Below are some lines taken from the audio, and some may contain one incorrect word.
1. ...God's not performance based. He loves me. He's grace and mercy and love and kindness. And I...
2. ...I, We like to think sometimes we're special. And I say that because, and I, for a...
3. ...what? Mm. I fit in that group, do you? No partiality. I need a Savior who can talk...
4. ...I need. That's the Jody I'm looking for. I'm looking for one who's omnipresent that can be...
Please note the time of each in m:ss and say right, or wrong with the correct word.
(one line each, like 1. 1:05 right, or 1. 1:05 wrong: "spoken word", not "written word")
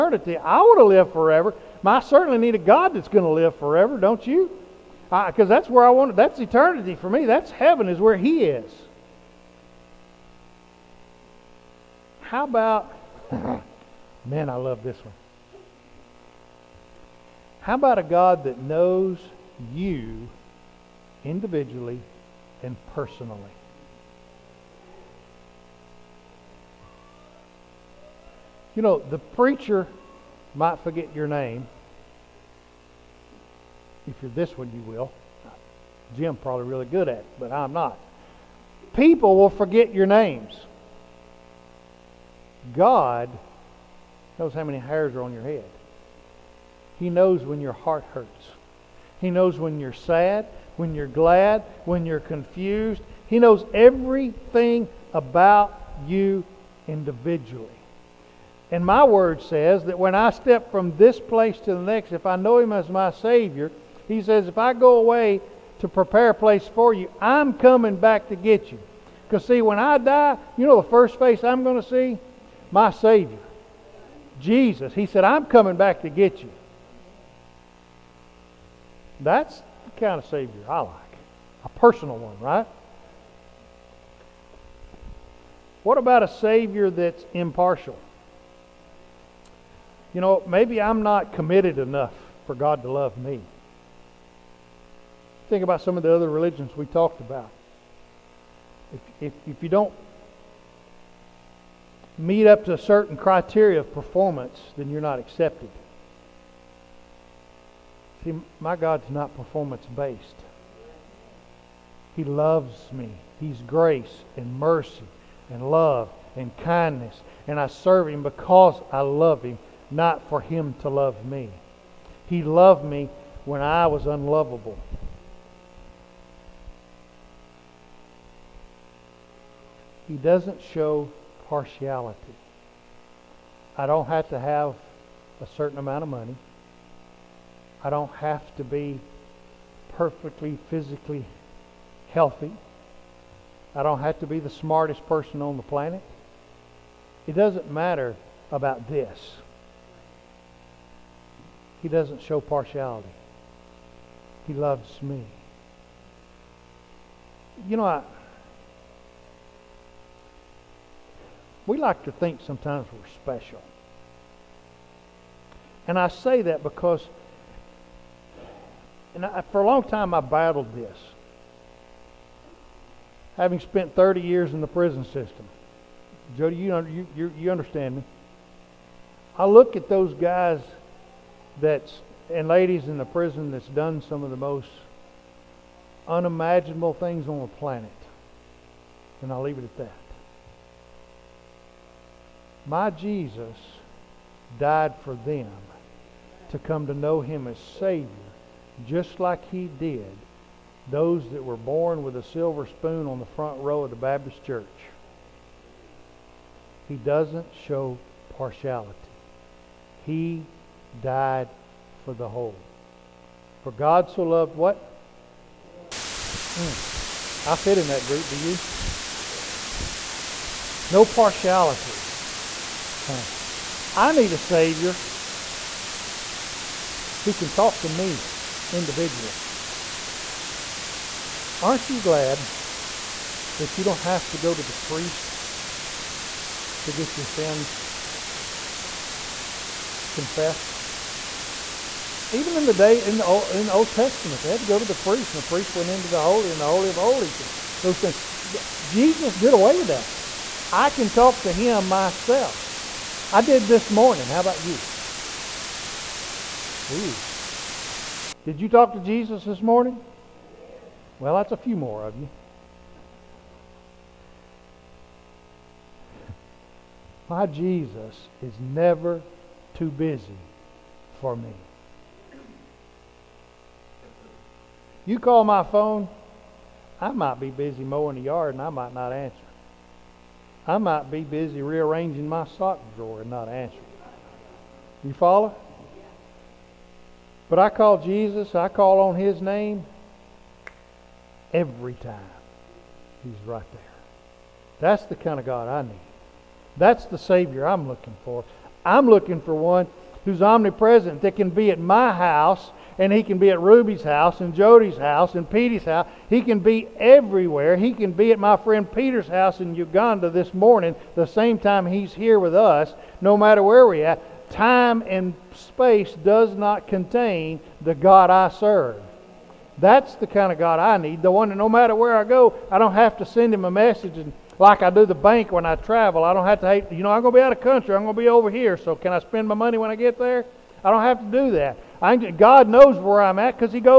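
1. 1:48 right
2. 2:37 right
3. 3:34 right
4. 4:55 wrong: "Savior", not "Jody".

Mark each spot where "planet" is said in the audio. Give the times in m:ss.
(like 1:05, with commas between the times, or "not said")
2:25, 3:07.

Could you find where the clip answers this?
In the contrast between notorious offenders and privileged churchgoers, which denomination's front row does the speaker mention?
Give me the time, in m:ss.
3:23.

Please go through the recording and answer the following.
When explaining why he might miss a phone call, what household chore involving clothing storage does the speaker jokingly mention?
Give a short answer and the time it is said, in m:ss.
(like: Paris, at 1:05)
rearranging my sock drawer, at 4:41.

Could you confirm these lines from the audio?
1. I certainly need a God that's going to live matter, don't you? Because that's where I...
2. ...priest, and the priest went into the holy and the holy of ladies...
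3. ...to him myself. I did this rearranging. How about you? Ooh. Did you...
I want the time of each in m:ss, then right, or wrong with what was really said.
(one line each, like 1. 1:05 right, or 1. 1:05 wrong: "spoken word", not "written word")
1. 0:01 wrong: "forever", not "matter"
2. 4:04 wrong: "holies", not "ladies"
3. 4:11 wrong: "morning", not "rearranging".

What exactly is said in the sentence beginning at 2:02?
He loved me when I was unlovable.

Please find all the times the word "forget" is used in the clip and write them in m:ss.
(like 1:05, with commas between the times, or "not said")
0:30, 0:39.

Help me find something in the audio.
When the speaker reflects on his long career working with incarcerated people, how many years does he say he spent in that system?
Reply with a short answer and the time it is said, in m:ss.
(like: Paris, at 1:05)
30, at 2:53.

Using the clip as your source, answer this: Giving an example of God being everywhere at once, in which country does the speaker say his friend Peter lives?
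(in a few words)
Uganda.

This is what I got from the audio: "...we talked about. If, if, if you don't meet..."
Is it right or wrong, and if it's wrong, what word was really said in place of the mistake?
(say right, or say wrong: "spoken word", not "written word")
right.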